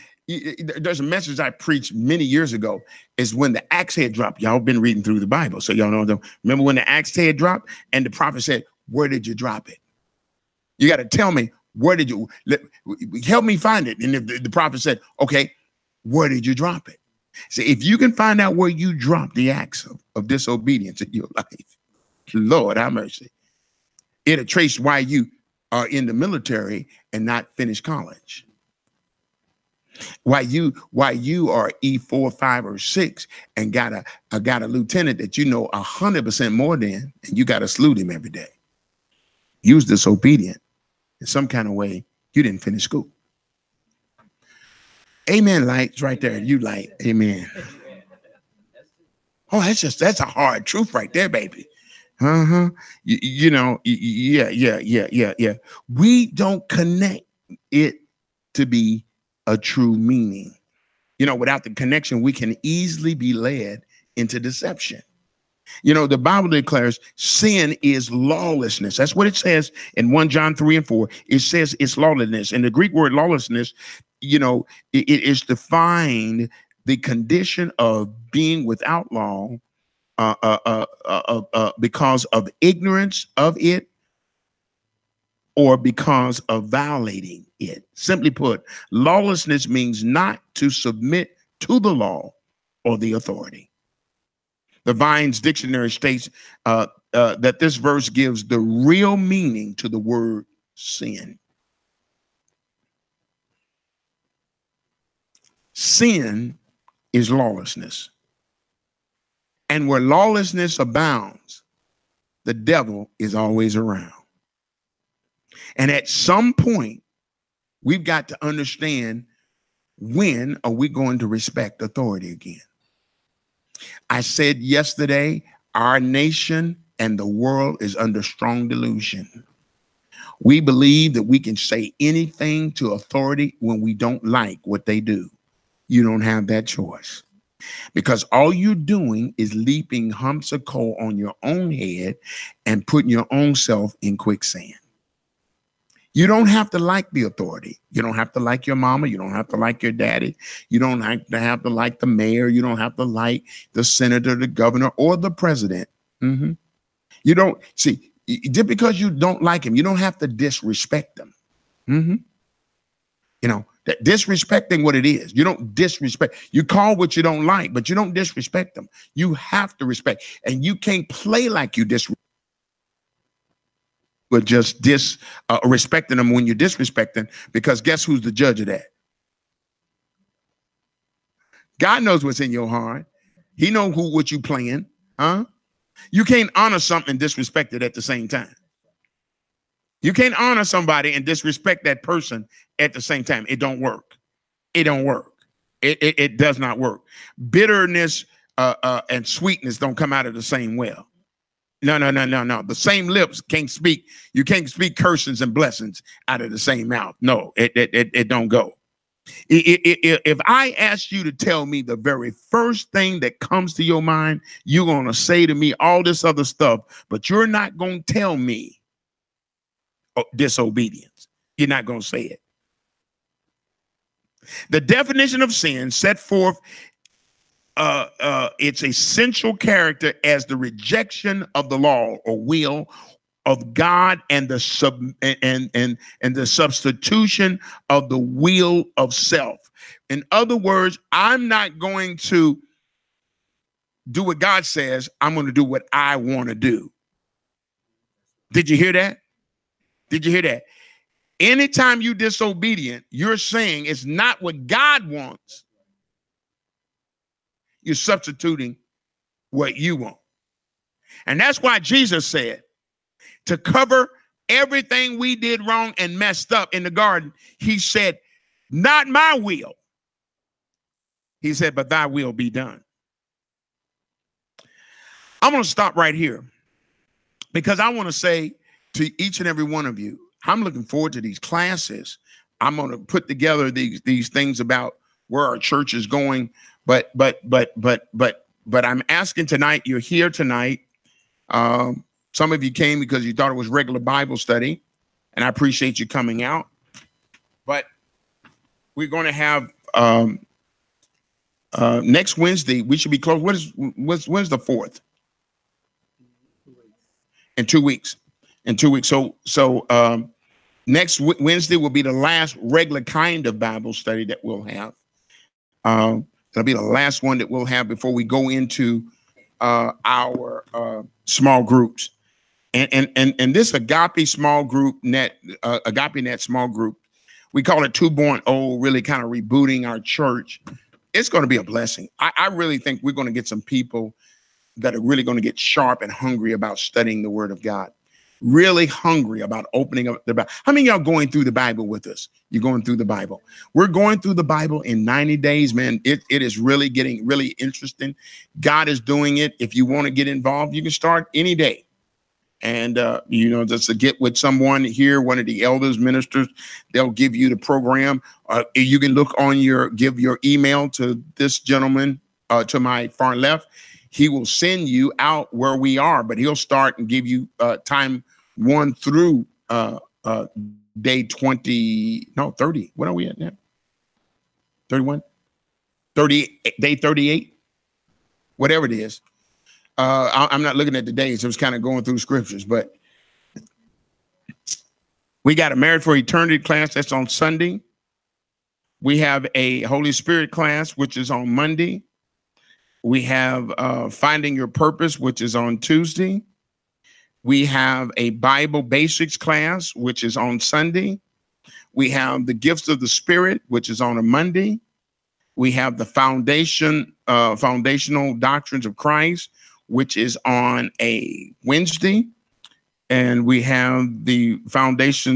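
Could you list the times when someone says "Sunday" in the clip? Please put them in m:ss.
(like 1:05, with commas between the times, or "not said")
6:27, 6:40.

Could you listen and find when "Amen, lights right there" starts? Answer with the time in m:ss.
0:45.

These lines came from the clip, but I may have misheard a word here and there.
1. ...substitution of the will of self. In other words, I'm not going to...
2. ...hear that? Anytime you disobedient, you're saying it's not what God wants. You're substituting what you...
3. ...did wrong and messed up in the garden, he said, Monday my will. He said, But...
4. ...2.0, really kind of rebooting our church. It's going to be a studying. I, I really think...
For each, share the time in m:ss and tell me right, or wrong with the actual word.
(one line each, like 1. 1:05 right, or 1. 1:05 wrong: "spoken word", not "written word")
1. 3:56 right
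2. 4:10 right
3. 4:25 wrong: "Not", not "Monday"
4. 5:27 wrong: "blessing", not "studying".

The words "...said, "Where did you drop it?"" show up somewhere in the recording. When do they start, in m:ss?
0:08.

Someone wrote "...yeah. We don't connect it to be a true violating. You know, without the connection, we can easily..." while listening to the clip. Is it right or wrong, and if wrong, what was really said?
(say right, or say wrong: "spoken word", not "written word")
wrong: "meaning", not "violating".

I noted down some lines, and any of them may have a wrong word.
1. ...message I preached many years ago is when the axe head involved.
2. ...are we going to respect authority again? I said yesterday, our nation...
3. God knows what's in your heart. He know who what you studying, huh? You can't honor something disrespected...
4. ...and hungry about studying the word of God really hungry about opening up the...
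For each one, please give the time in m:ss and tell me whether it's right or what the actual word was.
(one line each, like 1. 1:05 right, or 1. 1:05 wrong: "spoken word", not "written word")
1. 0:01 wrong: "dropped", not "involved"
2. 2:00 right
3. 3:01 wrong: "playing", not "studying"
4. 5:35 right.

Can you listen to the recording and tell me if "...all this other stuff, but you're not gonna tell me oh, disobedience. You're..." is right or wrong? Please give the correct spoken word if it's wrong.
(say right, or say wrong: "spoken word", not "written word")
right.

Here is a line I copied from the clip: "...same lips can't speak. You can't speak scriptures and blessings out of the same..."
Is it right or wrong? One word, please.
wrong.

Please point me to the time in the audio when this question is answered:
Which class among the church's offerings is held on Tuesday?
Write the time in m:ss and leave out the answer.
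6:34.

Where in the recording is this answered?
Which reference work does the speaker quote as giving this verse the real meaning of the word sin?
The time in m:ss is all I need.
1:34.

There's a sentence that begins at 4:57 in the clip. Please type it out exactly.
But we're going to have um, uh, next Wednesday.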